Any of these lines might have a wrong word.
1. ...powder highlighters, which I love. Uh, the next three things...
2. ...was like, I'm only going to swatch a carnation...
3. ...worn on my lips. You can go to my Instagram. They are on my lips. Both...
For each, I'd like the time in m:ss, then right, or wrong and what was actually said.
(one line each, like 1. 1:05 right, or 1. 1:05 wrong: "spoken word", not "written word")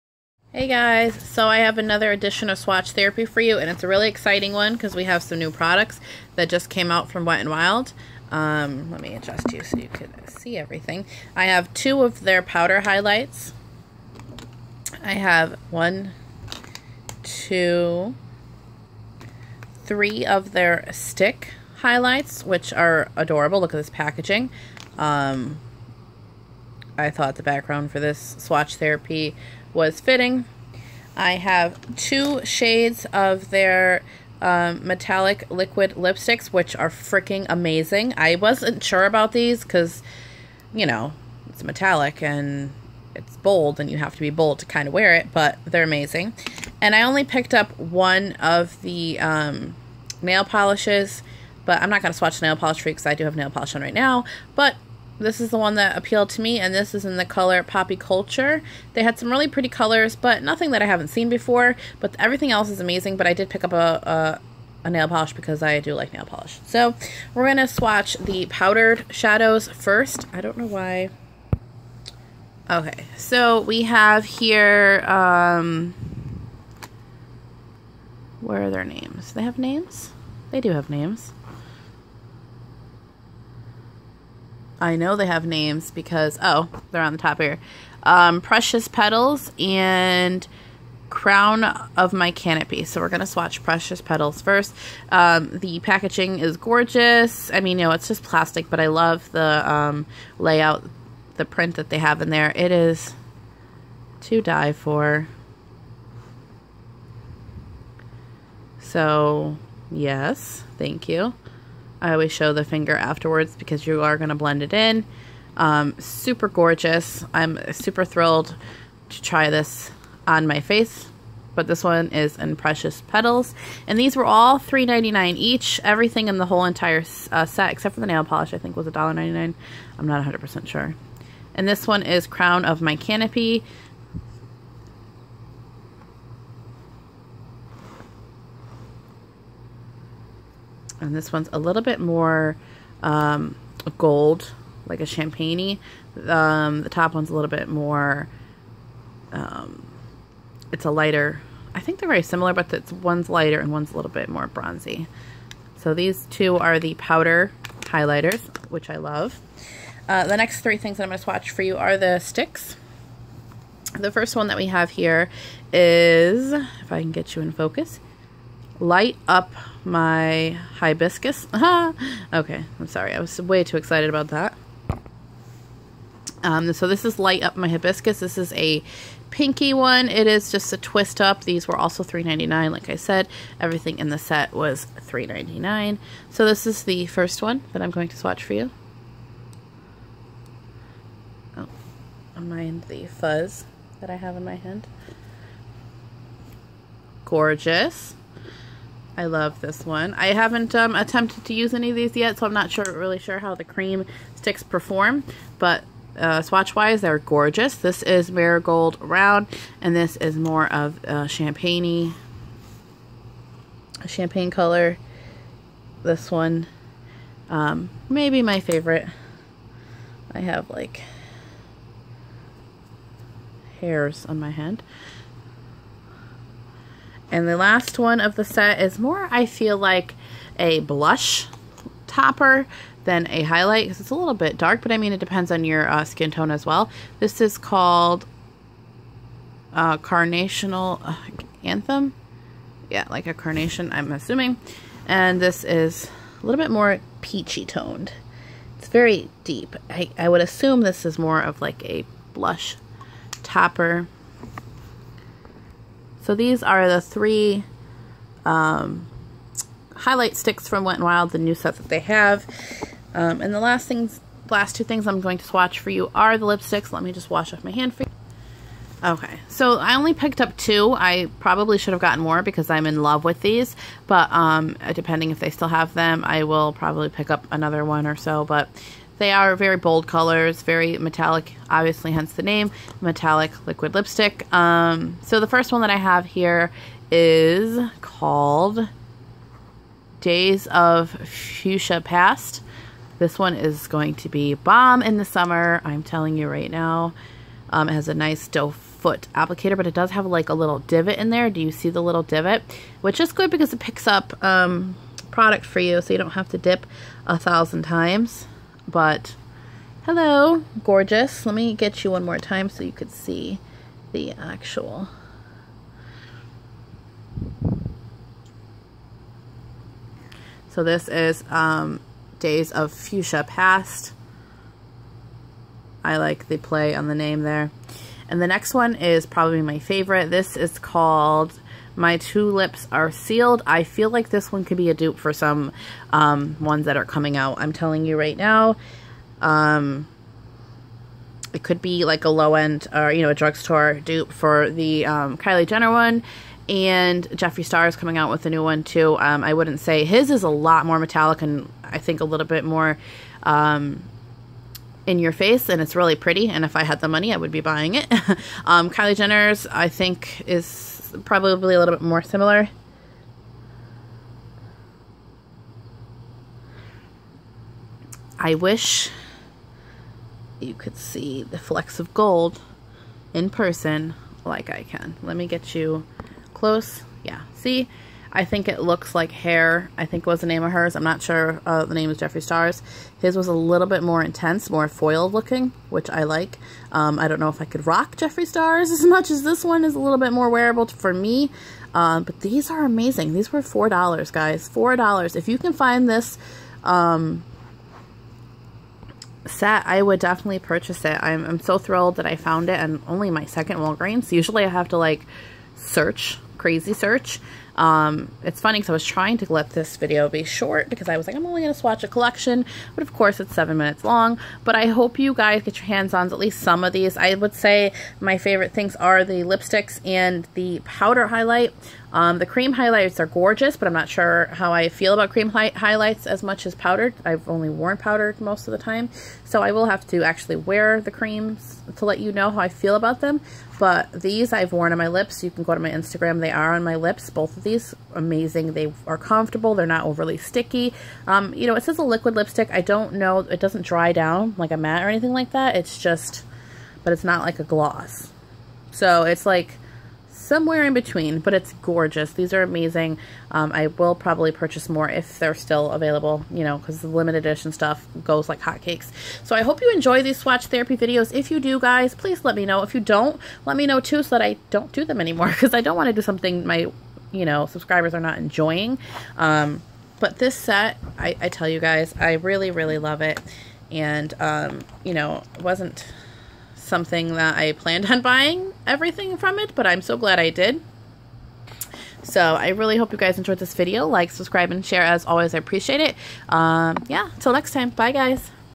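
1. 2:36 right
2. 6:51 wrong: "collection", not "carnation"
3. 7:14 right.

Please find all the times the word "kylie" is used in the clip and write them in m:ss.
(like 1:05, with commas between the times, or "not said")
5:45, 5:58.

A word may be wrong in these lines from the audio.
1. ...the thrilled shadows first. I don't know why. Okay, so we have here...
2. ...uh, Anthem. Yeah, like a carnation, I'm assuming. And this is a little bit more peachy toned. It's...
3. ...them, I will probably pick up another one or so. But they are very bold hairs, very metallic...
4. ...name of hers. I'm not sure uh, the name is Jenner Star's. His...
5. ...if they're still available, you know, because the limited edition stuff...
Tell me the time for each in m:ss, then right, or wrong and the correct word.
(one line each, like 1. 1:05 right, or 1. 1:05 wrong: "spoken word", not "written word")
1. 1:08 wrong: "powdered", not "thrilled"
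2. 4:01 right
3. 4:35 wrong: "colors", not "hairs"
4. 6:20 wrong: "Jeffree", not "Jenner"
5. 7:35 right.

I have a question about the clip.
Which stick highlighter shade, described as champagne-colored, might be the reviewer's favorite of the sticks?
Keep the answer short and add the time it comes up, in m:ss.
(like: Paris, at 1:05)
Marigold Round, at 3:28.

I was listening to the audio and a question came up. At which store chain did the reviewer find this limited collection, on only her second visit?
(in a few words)
Walgreens.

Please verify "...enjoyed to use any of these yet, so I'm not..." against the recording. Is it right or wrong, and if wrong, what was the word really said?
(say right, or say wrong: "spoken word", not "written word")
wrong: "attempted", not "enjoyed".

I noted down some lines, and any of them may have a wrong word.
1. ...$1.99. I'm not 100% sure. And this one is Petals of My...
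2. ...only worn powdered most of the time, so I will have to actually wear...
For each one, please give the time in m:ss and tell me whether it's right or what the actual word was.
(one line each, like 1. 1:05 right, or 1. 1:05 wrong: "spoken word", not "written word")
1. 2:08 wrong: "Crown", not "Petals"
2. 7:07 right.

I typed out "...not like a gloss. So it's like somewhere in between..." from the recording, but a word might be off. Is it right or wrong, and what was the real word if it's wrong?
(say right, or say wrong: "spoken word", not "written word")
right.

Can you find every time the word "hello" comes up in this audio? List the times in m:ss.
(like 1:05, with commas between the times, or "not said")
5:10.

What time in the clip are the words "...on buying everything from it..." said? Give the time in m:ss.
7:58.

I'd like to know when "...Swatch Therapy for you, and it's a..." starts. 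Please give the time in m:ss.
0:02.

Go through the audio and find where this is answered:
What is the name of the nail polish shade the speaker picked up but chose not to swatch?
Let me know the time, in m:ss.
0:57.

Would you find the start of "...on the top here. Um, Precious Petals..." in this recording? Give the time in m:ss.
1:27.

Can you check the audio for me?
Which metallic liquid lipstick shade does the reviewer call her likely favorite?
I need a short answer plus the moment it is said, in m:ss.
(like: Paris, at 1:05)
My Tulips Are Sealed, at 5:31.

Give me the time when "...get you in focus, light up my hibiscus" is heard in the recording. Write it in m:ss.
2:47.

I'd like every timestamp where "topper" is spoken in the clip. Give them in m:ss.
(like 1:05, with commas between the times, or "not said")
3:52, 4:13.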